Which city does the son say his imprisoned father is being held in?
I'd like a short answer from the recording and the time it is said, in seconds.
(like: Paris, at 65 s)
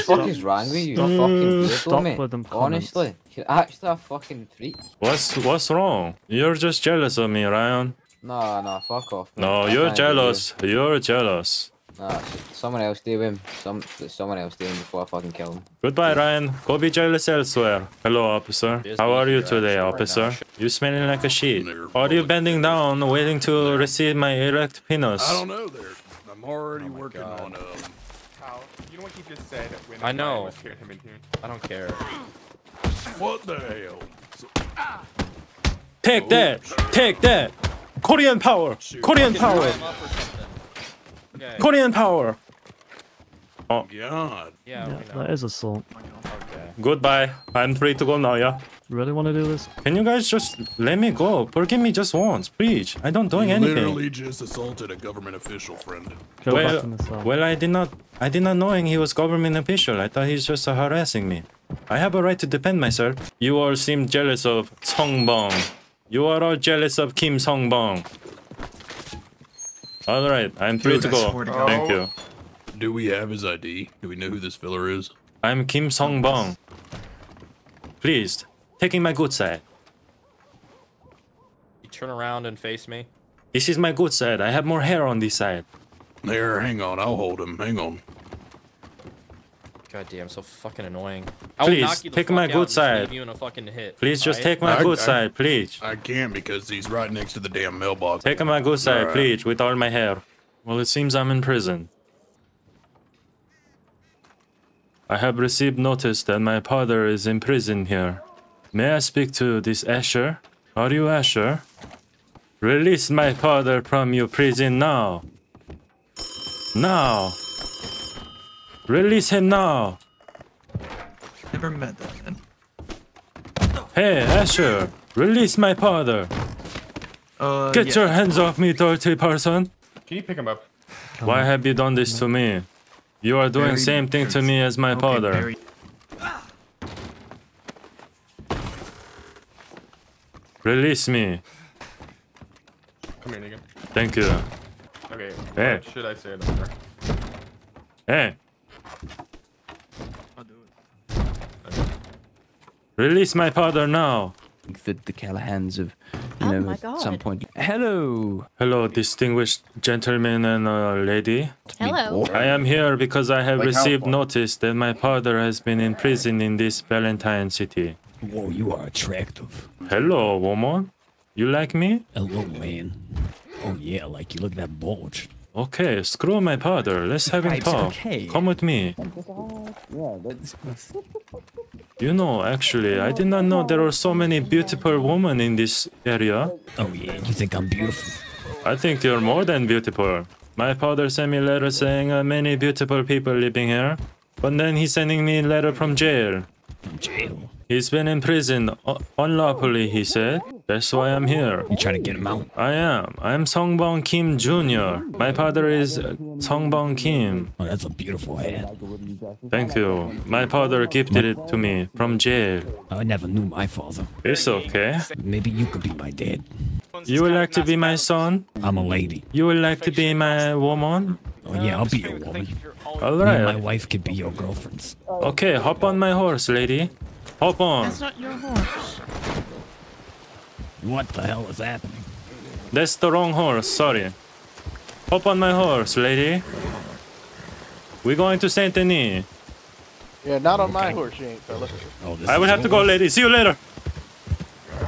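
Valentine, at 166 s.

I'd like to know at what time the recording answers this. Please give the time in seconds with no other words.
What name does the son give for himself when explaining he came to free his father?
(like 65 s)
203 s.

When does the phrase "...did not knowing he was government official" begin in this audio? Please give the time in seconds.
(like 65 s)
58 s.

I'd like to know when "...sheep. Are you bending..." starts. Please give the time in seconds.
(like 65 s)
21 s.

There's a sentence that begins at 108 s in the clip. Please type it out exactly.
May I speak to this Asher?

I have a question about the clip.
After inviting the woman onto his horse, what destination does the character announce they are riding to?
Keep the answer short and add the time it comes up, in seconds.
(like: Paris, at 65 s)
Saint Denis, at 238 s.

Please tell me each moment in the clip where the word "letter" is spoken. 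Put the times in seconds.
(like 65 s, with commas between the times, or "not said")
191 s, 195 s.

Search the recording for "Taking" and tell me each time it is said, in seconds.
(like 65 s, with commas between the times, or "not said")
78 s.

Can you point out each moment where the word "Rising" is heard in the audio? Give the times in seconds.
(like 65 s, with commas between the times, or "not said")
not said.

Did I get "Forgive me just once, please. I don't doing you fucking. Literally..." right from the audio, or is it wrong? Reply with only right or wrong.
wrong.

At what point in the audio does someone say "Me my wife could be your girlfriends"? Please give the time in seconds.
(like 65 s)
223 s.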